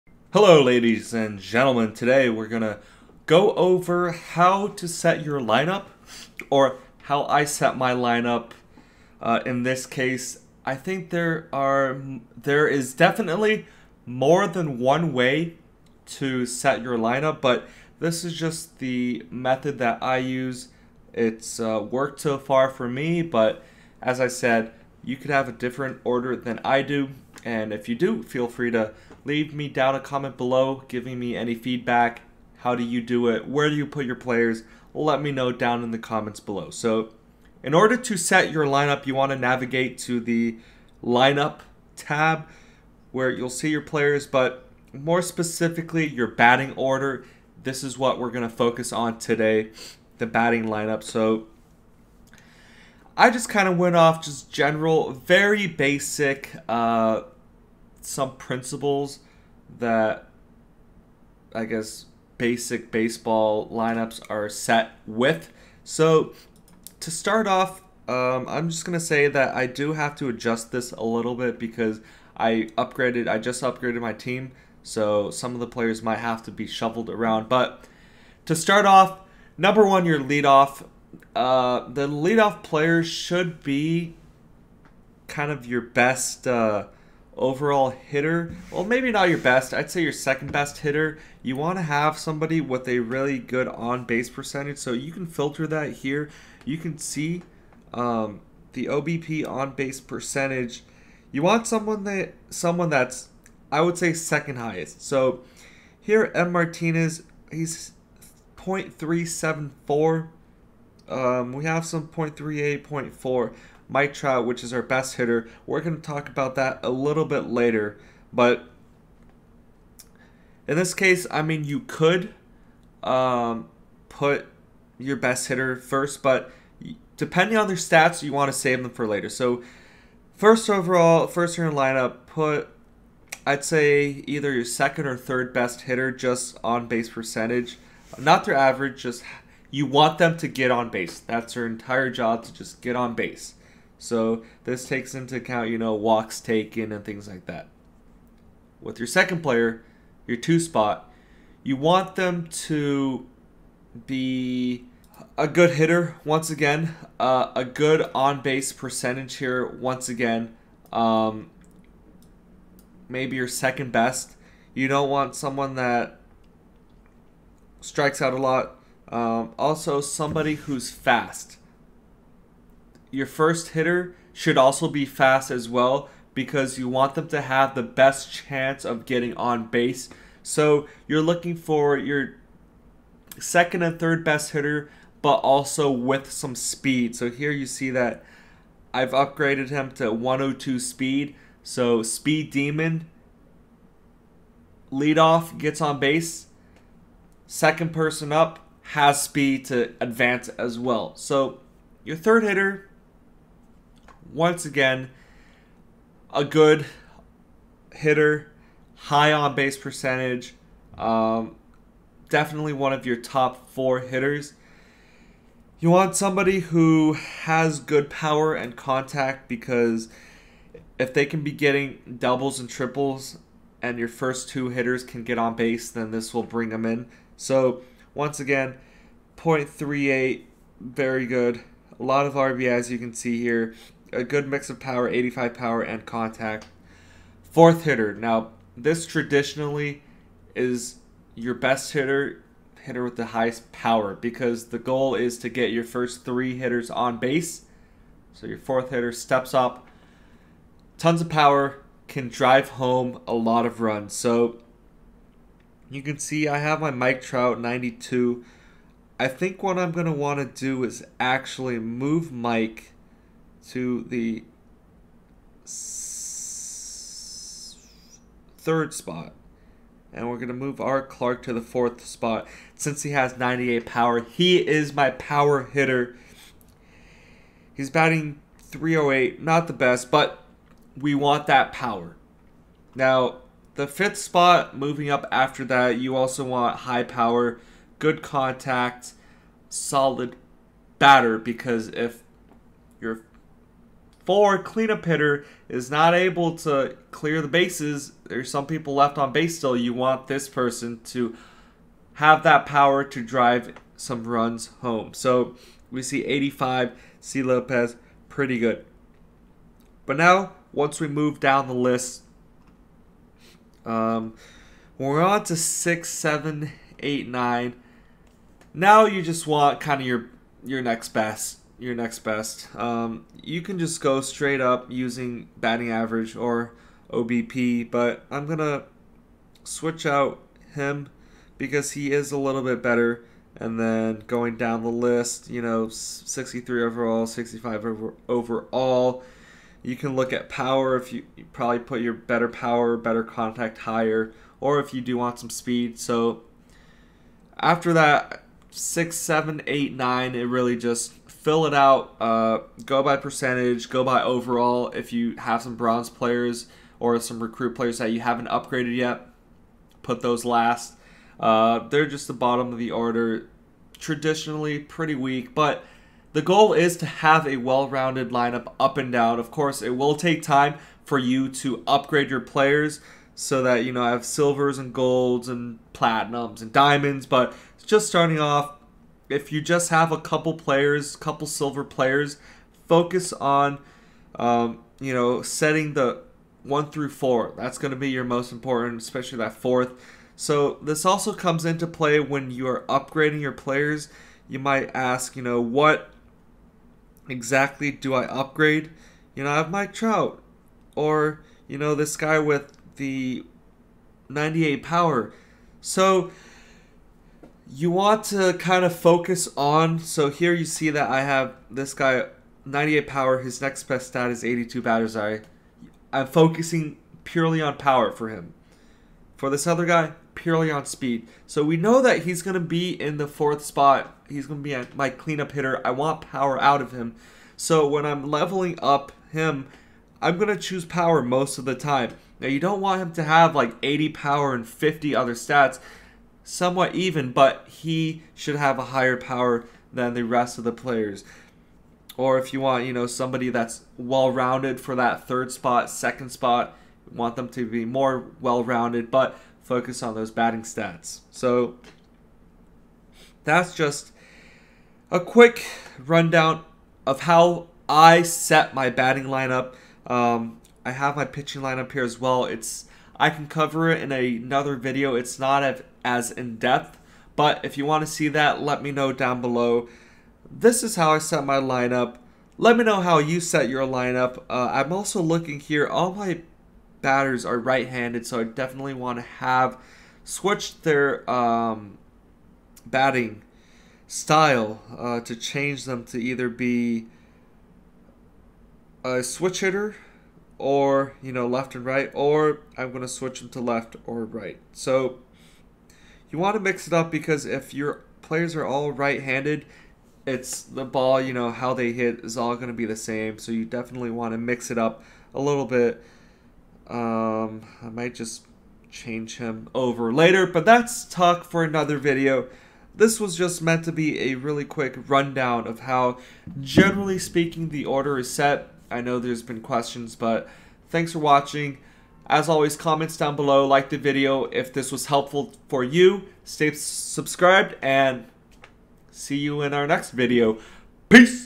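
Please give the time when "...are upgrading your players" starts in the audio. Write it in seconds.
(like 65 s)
392 s.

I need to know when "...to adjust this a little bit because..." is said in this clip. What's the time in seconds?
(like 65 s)
70 s.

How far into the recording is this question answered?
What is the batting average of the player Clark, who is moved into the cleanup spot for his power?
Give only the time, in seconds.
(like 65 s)
278 s.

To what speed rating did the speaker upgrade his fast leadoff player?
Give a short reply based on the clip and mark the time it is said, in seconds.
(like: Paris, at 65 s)
102, at 190 s.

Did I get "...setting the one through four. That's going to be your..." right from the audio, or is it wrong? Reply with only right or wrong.
right.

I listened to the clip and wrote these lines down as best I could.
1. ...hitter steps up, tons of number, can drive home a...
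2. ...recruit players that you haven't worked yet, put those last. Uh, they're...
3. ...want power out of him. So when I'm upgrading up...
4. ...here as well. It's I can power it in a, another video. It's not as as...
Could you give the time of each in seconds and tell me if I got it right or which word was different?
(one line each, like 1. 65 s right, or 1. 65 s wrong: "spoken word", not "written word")
1. 248 s wrong: "power", not "number"
2. 357 s wrong: "upgraded", not "worked"
3. 425 s wrong: "leveling", not "upgrading"
4. 461 s wrong: "cover", not "power".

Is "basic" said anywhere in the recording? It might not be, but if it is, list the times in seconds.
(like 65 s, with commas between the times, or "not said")
55 s, 62 s.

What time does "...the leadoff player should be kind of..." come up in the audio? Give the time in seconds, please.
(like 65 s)
81 s.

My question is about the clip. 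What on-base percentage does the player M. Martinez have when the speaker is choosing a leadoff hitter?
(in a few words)
0.374.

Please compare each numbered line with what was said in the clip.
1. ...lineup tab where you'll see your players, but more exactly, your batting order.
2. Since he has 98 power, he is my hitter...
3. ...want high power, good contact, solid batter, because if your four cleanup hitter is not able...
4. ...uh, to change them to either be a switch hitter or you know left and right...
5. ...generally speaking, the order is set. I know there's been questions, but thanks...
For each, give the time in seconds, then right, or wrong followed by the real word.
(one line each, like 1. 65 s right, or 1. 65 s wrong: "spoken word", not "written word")
1. 41 s wrong: "specifically", not "exactly"
2. 272 s wrong: "power", not "hitter"
3. 286 s right
4. 484 s right
5. 516 s right.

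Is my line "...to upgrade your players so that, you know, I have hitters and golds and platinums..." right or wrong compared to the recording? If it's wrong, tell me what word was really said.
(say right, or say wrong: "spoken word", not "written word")
wrong: "silvers", not "hitters".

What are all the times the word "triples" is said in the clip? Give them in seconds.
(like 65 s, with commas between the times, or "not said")
222 s.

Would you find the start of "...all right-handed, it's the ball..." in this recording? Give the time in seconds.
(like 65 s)
498 s.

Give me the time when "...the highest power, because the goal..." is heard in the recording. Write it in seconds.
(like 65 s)
243 s.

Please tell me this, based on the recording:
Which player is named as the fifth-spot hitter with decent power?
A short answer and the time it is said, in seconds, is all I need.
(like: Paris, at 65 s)
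C. Lopez, at 307 s.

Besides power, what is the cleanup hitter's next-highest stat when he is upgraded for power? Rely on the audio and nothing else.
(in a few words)
82 batter's eye.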